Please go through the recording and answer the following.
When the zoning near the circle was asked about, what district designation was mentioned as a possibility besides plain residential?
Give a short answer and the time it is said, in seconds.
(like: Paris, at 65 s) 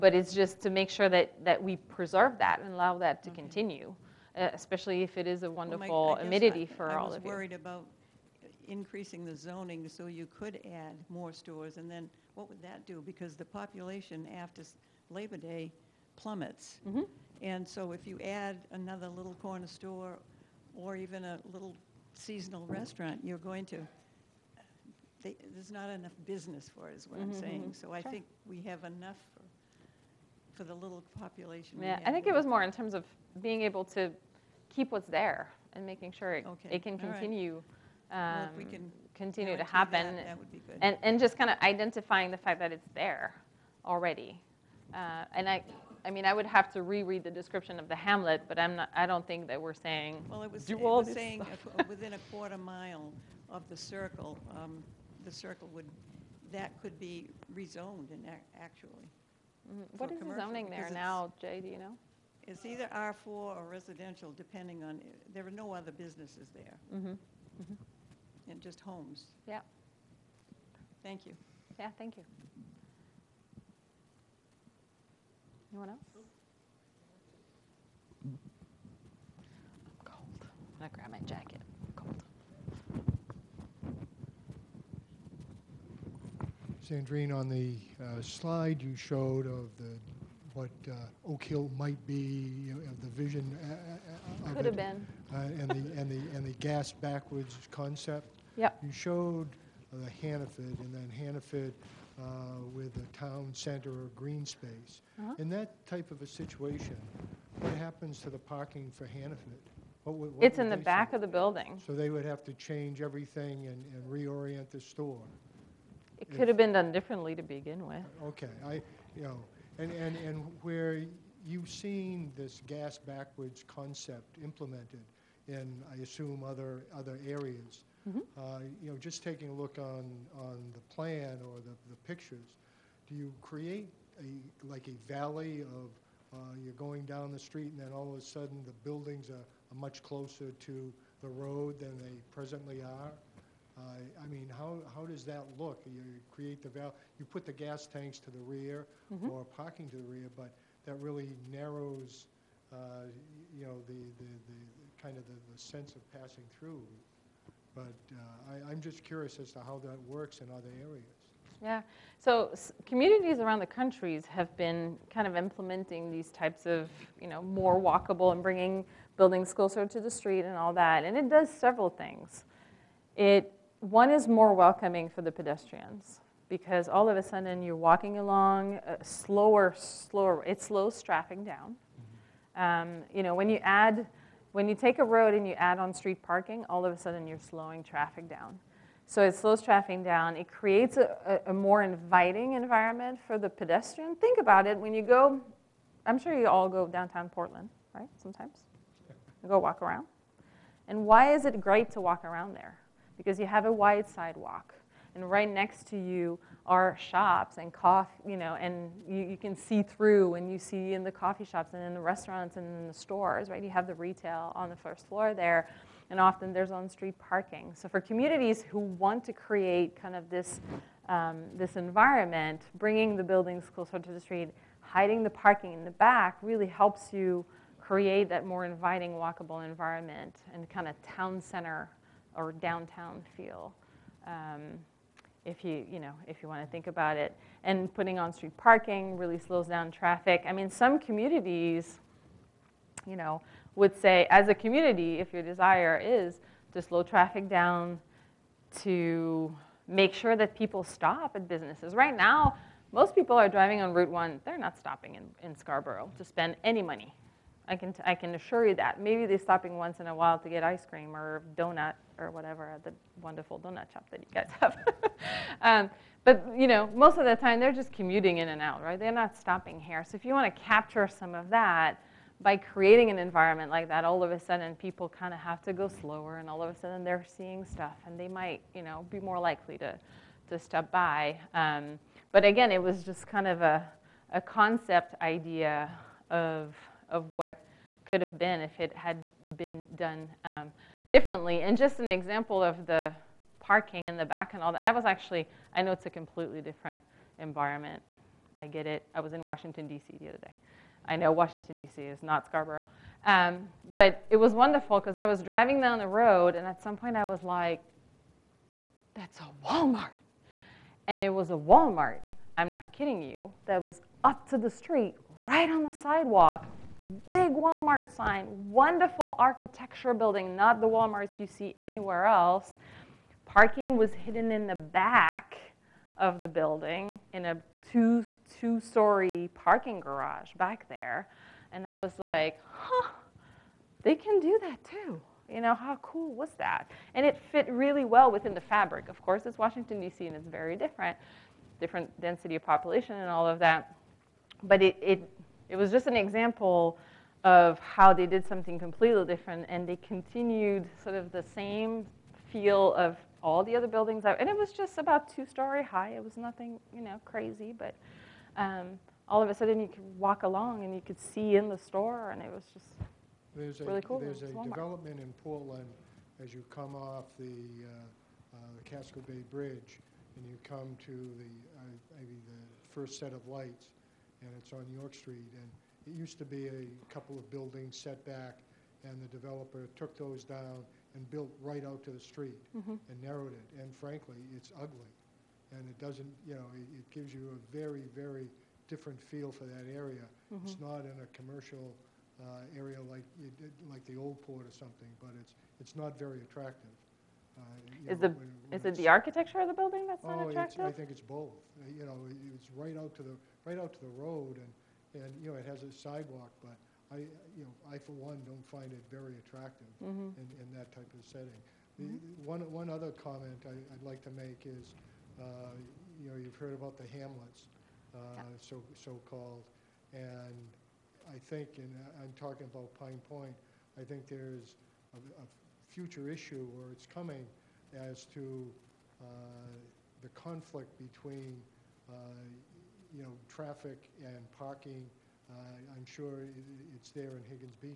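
R4, at 62 s.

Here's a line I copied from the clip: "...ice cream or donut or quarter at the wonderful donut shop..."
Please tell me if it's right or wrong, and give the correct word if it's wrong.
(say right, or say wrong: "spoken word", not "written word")
wrong: "whatever", not "quarter".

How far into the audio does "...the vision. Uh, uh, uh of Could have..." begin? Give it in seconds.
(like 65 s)
93 s.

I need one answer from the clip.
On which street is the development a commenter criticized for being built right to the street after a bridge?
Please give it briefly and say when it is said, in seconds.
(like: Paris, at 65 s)
York Street, at 374 s.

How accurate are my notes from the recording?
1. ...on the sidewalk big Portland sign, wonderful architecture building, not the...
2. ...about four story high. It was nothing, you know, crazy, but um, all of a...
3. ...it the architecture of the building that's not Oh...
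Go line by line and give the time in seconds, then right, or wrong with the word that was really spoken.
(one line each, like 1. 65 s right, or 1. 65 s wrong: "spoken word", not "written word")
1. 315 s wrong: "Walmart", not "Portland"
2. 354 s wrong: "two", not "four"
3. 398 s right.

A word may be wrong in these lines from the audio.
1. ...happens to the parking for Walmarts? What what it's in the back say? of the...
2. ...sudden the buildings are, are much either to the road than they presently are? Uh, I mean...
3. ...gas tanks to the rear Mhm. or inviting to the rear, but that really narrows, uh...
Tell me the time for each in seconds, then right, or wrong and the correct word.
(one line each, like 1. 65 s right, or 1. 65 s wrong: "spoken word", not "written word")
1. 107 s wrong: "Hannaford", not "Walmarts"
2. 138 s wrong: "closer", not "either"
3. 147 s wrong: "parking", not "inviting".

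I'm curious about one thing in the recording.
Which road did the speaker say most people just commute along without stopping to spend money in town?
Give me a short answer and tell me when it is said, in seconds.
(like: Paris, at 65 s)
Route 1, at 253 s.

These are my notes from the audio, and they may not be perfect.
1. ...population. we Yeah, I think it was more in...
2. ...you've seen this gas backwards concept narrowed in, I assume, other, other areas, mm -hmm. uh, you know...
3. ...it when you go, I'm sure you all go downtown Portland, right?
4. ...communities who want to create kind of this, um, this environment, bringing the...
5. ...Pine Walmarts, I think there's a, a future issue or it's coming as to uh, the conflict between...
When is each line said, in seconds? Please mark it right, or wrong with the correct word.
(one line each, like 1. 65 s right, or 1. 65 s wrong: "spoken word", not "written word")
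1. 31 s right
2. 121 s wrong: "implemented", not "narrowed"
3. 194 s right
4. 217 s right
5. 422 s wrong: "Point", not "Walmarts".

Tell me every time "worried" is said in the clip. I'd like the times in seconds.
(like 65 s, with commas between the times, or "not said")
7 s.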